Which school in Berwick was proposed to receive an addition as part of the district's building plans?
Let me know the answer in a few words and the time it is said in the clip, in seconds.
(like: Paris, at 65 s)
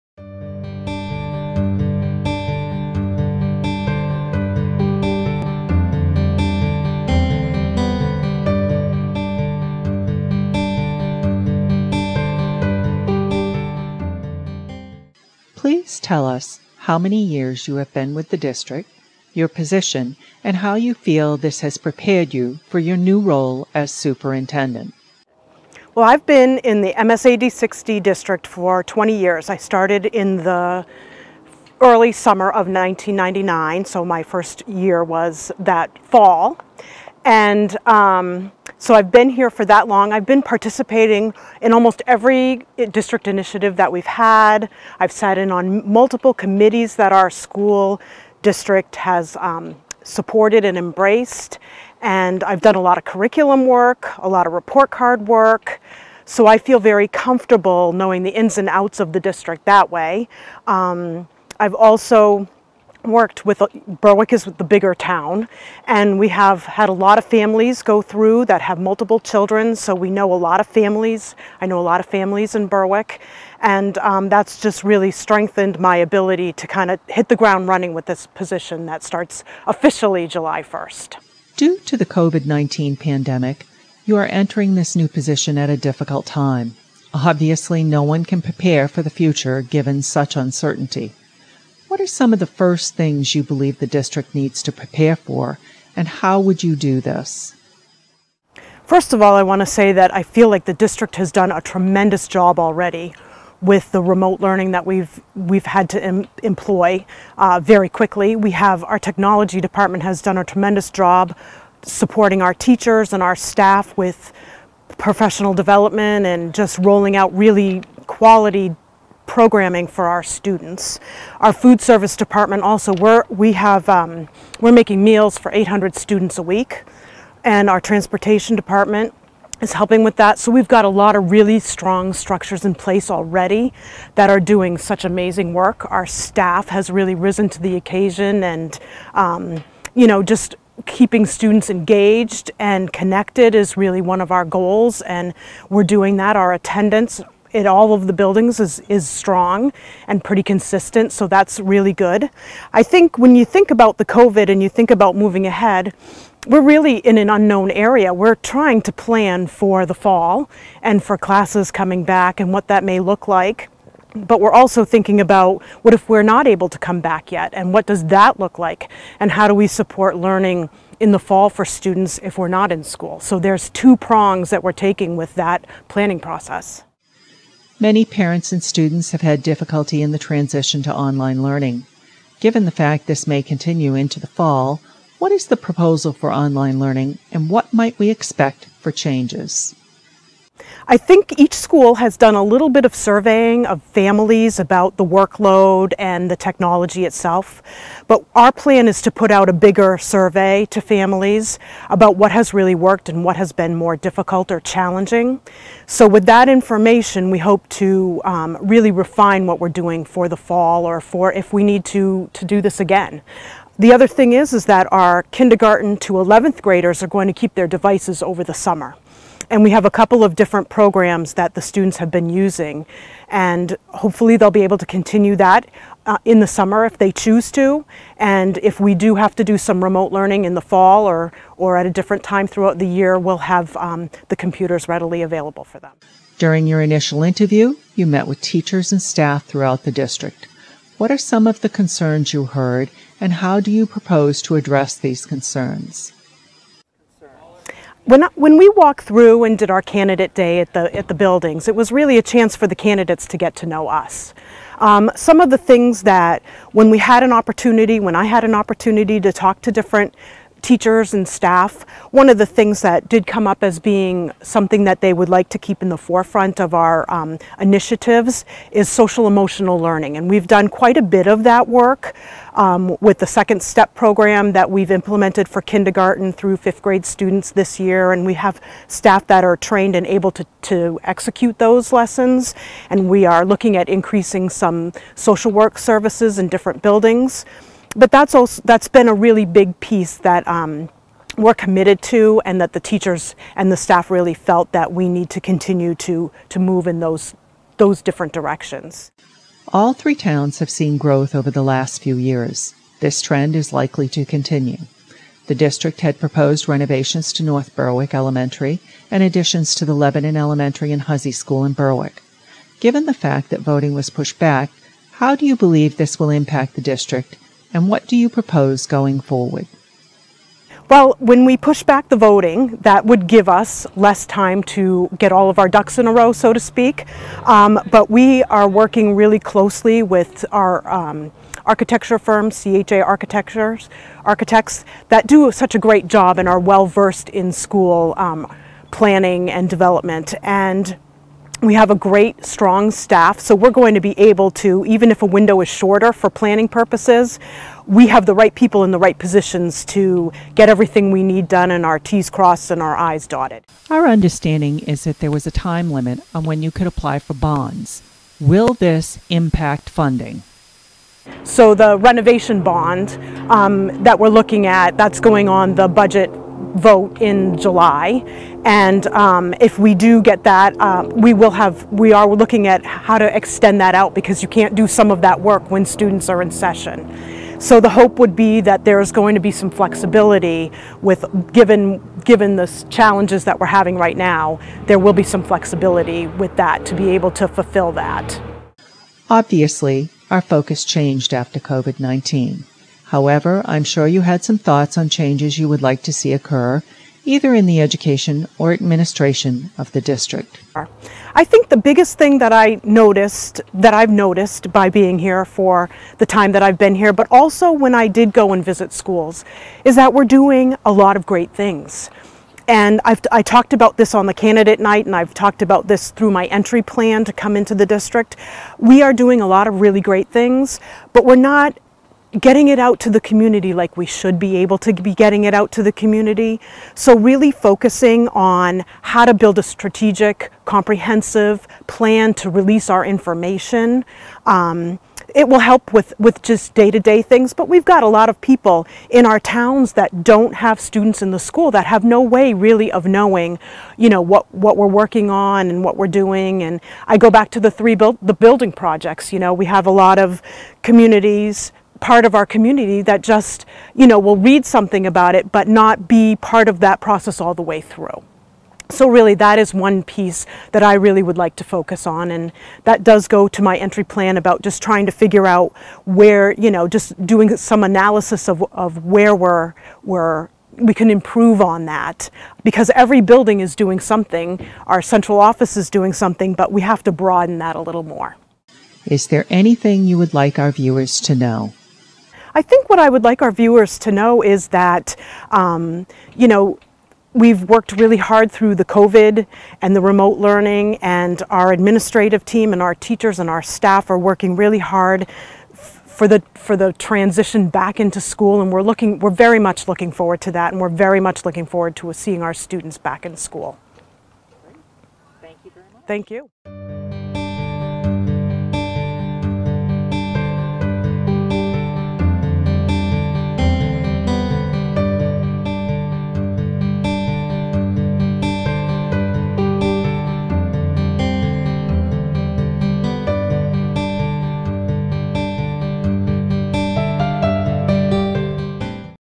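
Hussey School, at 311 s.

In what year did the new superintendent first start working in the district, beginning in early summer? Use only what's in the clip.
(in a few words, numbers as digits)
1999.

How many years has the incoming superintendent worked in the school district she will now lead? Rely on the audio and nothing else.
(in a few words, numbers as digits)
20.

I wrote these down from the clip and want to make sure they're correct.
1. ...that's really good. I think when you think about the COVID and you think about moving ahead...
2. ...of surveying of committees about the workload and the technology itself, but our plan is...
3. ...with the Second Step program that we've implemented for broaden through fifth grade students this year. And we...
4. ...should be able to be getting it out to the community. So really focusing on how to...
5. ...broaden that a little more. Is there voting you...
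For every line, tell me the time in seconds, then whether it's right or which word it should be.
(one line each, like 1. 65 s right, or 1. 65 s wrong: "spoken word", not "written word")
1. 151 s right
2. 192 s wrong: "families", not "committees"
3. 273 s wrong: "kindergarten", not "broaden"
4. 424 s right
5. 477 s wrong: "anything", not "voting".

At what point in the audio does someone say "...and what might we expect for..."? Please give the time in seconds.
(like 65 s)
187 s.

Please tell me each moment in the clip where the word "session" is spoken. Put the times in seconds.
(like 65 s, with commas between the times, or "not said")
376 s.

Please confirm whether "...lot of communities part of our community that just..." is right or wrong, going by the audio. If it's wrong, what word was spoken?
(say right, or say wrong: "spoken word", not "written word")
right.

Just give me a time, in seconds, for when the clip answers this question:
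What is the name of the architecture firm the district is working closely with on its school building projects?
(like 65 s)
332 s.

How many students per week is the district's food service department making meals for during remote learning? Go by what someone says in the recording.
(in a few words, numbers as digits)
800.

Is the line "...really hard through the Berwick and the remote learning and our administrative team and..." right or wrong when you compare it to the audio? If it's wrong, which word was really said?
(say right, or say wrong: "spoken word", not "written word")
wrong: "COVID", not "Berwick".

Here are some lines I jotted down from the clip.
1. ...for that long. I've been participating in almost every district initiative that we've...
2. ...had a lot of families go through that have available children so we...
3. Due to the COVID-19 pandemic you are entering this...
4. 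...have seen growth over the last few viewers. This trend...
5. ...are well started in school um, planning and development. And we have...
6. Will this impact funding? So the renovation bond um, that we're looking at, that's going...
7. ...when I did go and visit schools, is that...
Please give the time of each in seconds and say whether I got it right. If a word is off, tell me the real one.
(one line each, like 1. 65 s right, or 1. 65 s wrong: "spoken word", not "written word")
1. 39 s right
2. 66 s wrong: "multiple", not "available"
3. 81 s right
4. 300 s wrong: "years", not "viewers"
5. 336 s wrong: "versed", not "started"
6. 358 s right
7. 407 s right.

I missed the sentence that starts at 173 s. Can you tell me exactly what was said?
So there's two prongs that we're taking with that planning process.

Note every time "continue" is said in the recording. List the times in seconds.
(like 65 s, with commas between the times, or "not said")
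183 s, 224 s, 295 s, 304 s.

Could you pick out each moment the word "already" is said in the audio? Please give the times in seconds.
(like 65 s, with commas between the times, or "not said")
102 s, 133 s.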